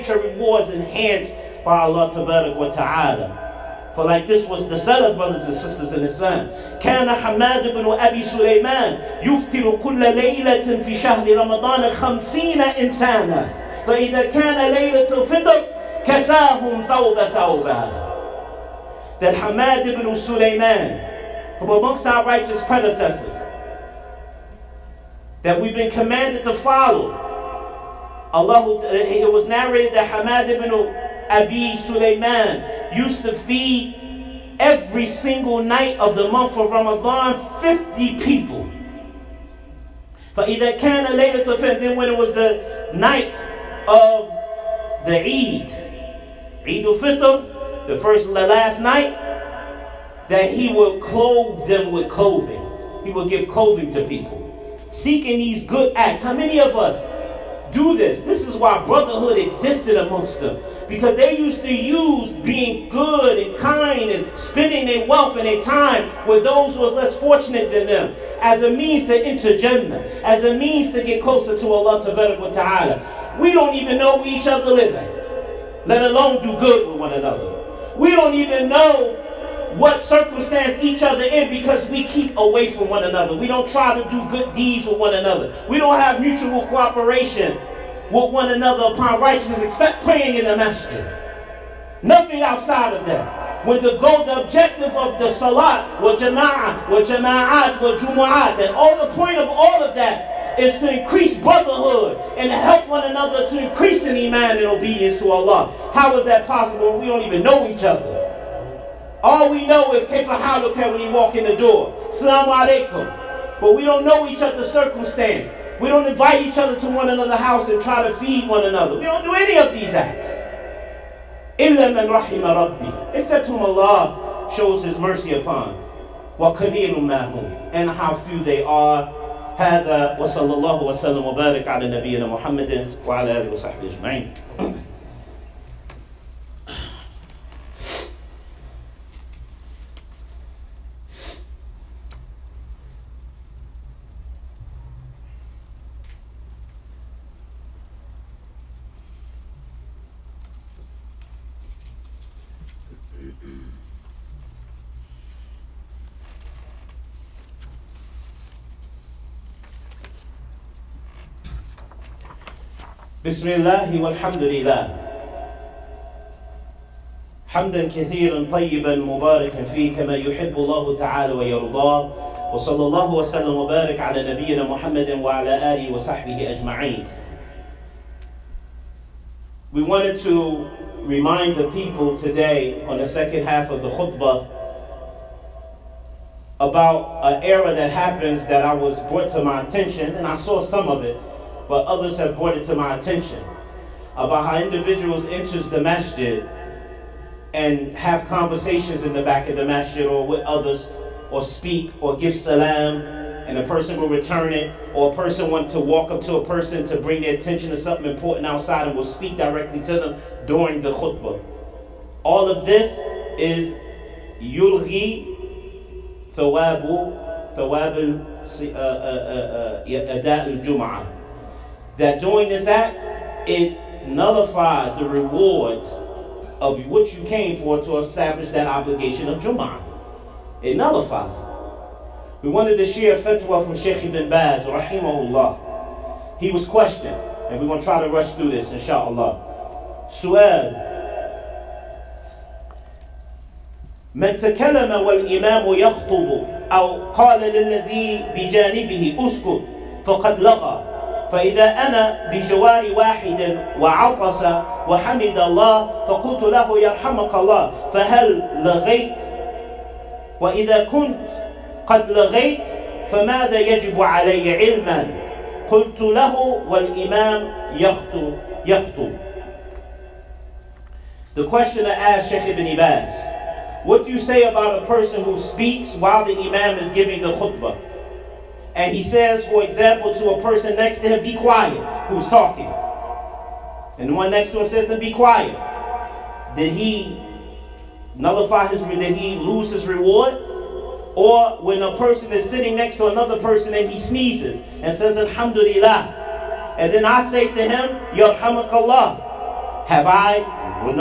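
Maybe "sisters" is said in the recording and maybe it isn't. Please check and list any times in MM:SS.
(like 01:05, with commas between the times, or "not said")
00:05.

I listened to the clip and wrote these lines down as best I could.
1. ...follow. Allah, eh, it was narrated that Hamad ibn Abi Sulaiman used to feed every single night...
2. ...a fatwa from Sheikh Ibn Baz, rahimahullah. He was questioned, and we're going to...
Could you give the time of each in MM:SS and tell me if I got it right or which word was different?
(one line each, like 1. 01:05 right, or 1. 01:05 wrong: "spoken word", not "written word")
1. 00:26 right
2. 03:53 right.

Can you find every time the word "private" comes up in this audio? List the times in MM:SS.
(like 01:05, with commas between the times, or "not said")
not said.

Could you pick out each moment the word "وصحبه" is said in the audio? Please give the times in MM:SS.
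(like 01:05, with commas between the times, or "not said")
02:13, 02:55.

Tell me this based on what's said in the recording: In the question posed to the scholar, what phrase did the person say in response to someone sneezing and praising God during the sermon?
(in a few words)
Yarhamakallah.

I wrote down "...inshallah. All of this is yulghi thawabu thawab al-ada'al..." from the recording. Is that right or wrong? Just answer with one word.
wrong.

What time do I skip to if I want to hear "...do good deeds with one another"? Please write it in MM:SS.
01:24.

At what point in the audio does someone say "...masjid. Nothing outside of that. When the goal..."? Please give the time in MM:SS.
01:30.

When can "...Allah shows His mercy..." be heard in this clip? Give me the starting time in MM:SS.
02:03.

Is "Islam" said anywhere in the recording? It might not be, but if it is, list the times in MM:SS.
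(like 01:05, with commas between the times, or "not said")
00:06.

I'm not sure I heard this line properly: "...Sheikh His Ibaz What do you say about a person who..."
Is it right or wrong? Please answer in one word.
wrong.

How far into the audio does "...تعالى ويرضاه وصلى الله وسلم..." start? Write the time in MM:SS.
02:50.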